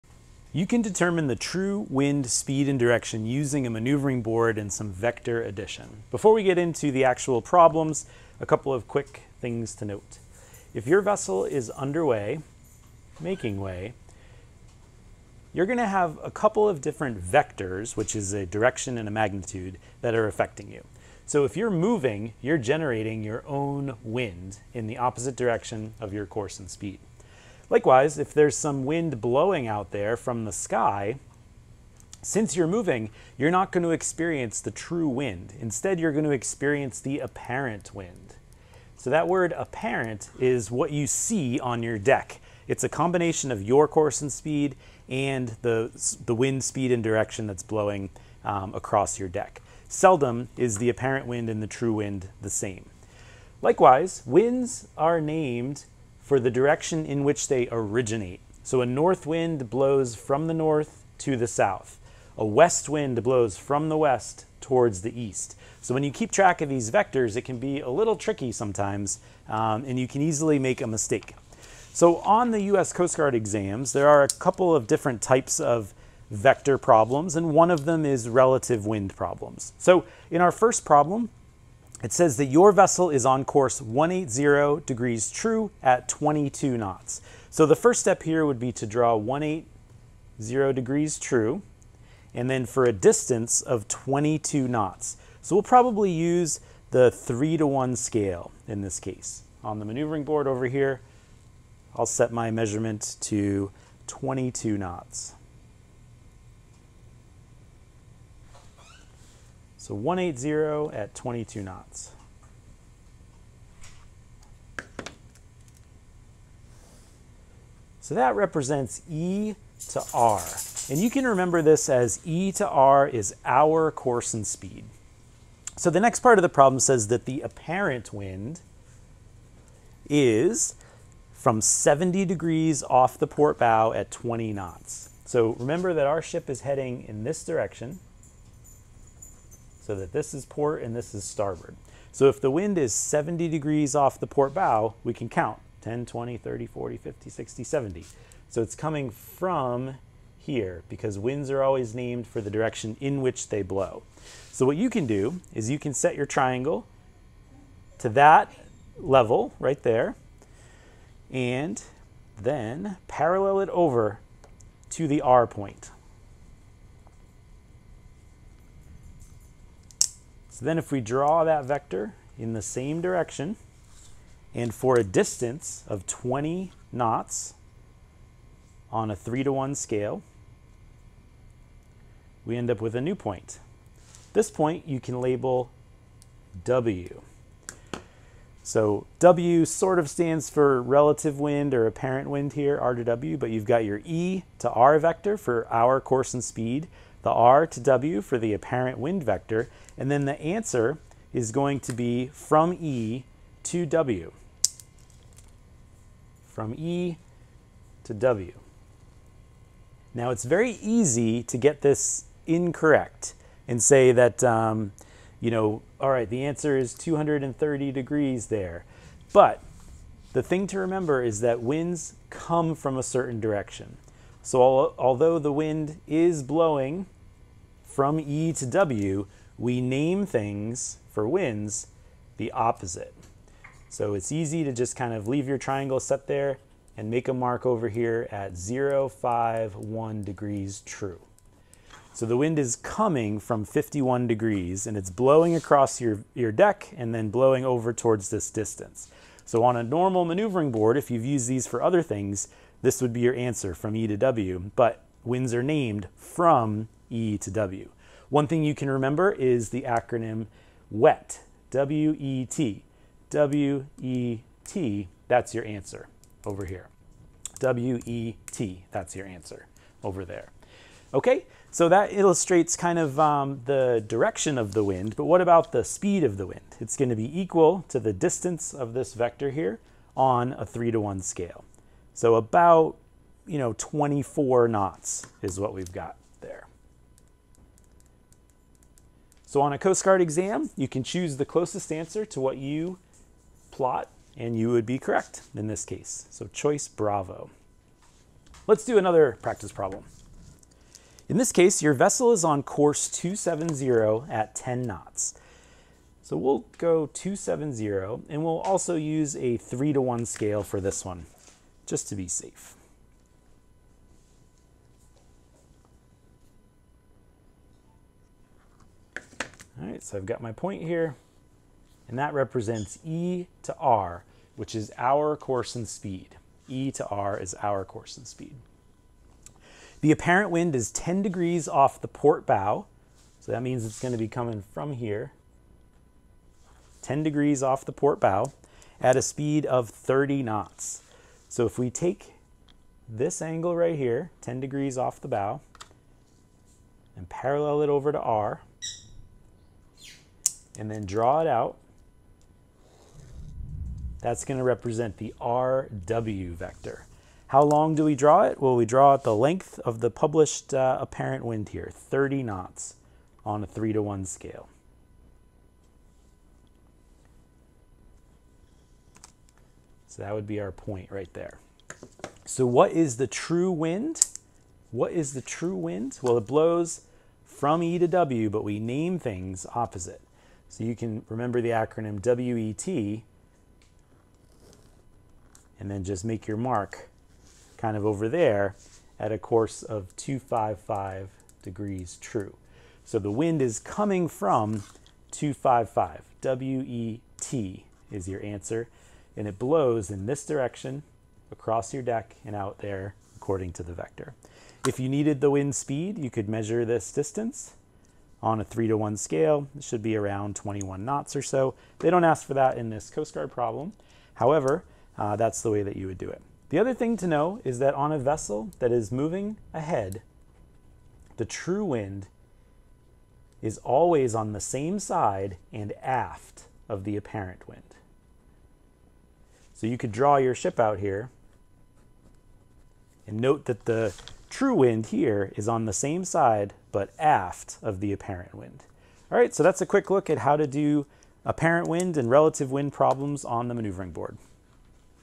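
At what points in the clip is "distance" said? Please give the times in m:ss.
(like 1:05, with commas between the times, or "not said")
1:32, 2:55, 4:08, 4:38, 6:47.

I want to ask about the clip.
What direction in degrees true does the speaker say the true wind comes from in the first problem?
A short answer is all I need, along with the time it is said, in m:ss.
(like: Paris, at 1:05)
51, at 4:03.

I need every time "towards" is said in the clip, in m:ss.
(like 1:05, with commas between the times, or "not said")
1:04, 4:07.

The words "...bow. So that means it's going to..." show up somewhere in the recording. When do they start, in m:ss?
5:32.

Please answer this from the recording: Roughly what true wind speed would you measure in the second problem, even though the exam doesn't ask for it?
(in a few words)
21 knots.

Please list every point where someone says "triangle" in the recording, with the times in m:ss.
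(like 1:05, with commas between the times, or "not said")
2:36, 3:55.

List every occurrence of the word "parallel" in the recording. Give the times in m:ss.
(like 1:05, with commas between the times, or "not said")
2:43, 5:47.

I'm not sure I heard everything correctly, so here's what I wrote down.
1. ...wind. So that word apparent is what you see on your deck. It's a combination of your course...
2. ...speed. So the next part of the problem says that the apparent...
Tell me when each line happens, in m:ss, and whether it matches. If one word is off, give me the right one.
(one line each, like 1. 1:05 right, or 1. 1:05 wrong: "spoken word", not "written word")
1. 0:37 right
2. 2:04 right.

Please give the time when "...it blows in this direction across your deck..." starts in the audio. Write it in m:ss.
6:39.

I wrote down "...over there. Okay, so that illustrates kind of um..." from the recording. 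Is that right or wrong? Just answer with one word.
right.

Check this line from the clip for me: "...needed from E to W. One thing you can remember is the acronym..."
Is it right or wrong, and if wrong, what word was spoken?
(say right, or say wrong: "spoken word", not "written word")
wrong: "named", not "needed".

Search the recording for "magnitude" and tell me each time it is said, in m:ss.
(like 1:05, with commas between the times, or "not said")
0:19.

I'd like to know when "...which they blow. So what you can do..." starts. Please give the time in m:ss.
2:33.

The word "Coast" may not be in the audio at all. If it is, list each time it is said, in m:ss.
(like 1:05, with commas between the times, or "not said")
1:12, 4:49, 6:53.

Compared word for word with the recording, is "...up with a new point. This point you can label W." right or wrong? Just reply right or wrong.
right.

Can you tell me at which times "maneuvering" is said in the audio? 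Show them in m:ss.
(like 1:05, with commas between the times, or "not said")
0:03, 1:39, 4:10, 7:23.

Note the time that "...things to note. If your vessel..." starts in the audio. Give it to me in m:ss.
0:09.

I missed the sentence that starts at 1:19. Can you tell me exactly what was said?
So in our first problem, it says that your vessel is on course 180 degrees true at 22 knots.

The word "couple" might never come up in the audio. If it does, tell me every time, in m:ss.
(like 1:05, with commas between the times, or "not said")
0:08, 0:16, 1:14.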